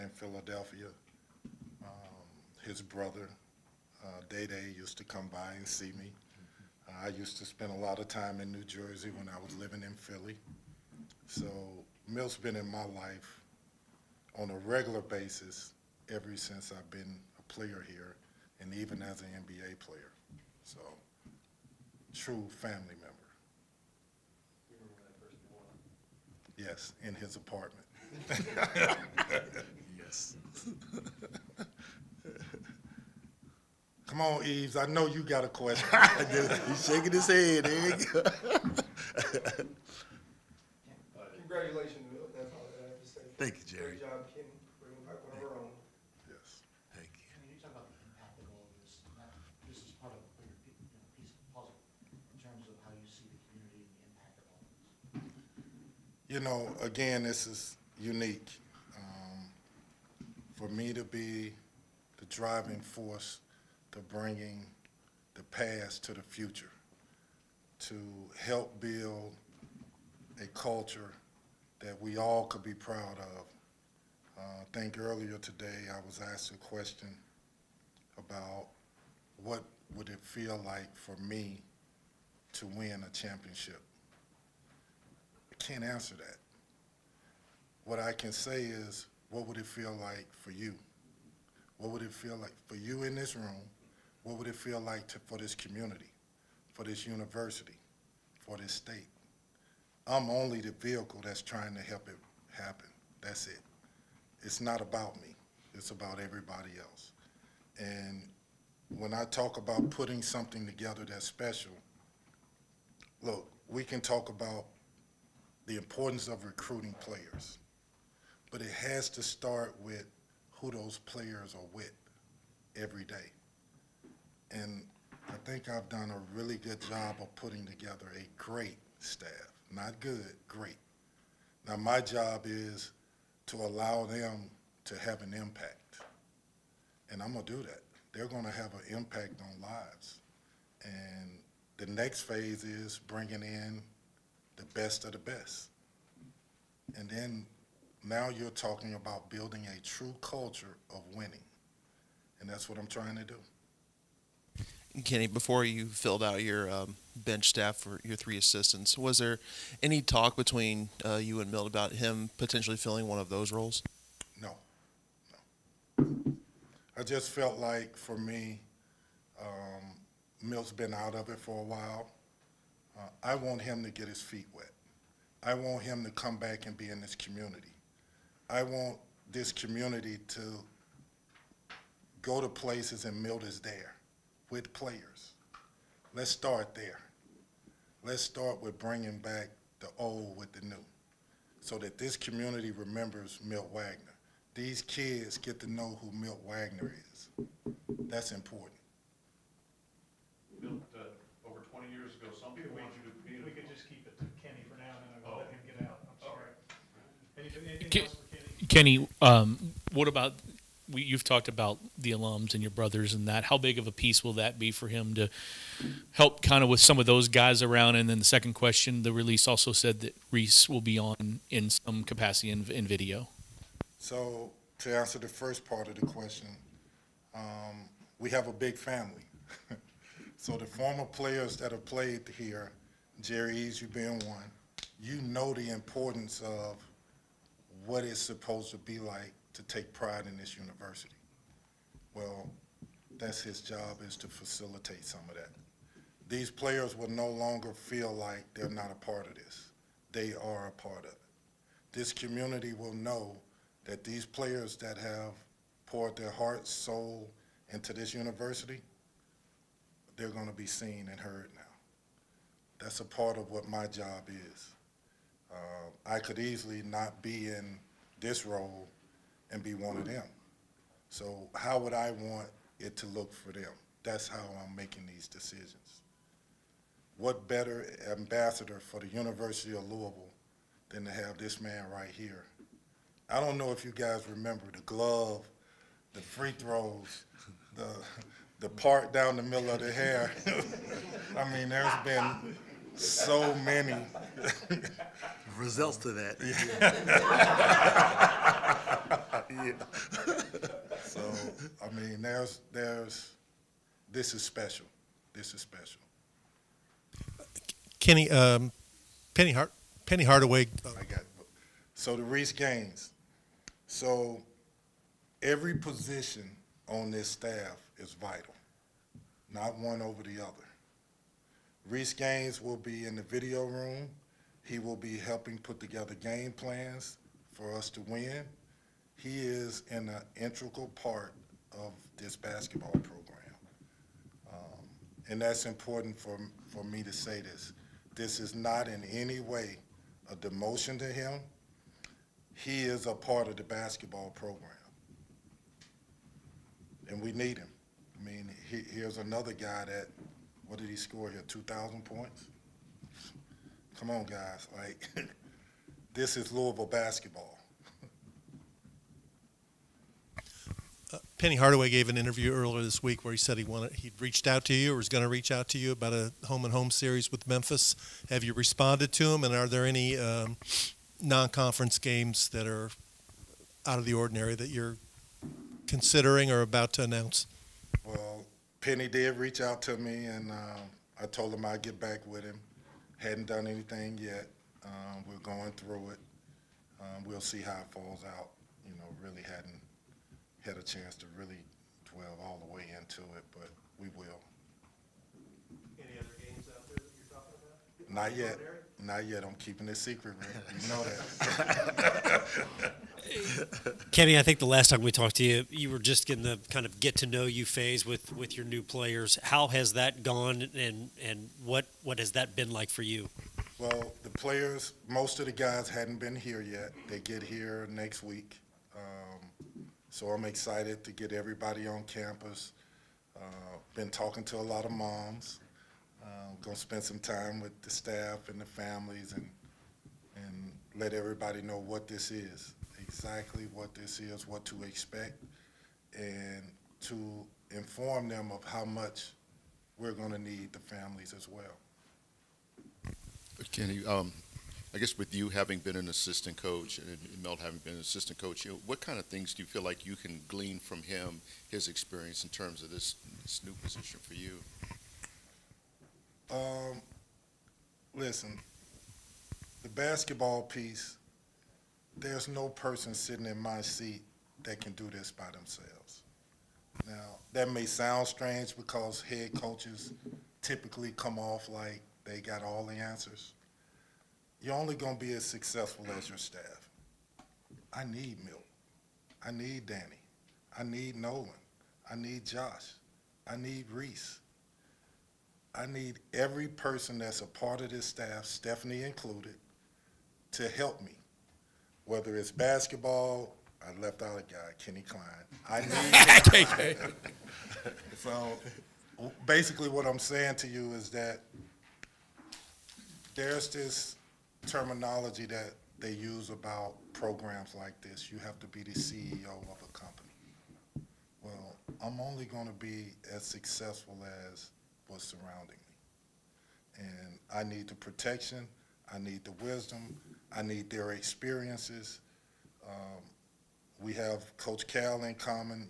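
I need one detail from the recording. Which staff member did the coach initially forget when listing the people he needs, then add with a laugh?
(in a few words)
Kenny Klein.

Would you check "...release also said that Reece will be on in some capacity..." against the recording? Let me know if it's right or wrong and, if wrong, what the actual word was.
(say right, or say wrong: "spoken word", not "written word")
right.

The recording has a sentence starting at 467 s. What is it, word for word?
Now, that may sound strange because head coaches typically come off like they got all the answers.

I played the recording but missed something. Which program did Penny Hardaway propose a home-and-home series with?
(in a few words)
Memphis.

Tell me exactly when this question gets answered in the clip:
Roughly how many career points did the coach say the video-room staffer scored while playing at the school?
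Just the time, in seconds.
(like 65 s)
351 s.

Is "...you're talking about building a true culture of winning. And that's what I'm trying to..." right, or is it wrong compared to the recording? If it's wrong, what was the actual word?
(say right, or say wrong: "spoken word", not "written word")
right.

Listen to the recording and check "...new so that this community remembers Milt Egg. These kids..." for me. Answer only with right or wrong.
wrong.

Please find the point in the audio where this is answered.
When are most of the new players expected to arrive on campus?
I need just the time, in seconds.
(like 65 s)
417 s.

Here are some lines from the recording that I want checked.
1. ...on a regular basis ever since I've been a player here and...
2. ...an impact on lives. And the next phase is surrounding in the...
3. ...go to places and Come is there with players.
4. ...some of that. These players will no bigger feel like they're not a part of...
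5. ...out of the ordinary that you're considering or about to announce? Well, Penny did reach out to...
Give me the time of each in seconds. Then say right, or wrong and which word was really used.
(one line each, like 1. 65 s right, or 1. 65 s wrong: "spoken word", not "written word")
1. 14 s right
2. 138 s wrong: "bringing", not "surrounding"
3. 182 s wrong: "Milt", not "Come"
4. 245 s wrong: "longer", not "bigger"
5. 373 s right.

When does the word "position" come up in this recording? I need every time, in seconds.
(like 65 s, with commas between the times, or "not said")
315 s, 453 s.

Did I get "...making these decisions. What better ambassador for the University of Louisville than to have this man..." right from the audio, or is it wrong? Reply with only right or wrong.
right.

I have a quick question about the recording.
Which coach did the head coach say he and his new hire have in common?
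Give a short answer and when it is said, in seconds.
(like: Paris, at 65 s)
Coach Cal, at 524 s.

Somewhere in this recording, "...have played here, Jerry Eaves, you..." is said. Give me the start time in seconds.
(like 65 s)
231 s.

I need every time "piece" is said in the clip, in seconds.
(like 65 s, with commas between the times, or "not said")
51 s, 213 s, 460 s.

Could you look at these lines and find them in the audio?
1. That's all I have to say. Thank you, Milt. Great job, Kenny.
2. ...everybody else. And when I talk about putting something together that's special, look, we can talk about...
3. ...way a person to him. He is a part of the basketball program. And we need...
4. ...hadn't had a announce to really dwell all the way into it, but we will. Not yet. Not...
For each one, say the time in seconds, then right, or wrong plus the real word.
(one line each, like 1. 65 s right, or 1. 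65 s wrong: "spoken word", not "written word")
1. 42 s wrong: "Jerry", not "Milt"
2. 106 s right
3. 339 s wrong: "demotion", not "person"
4. 389 s wrong: "chance", not "announce".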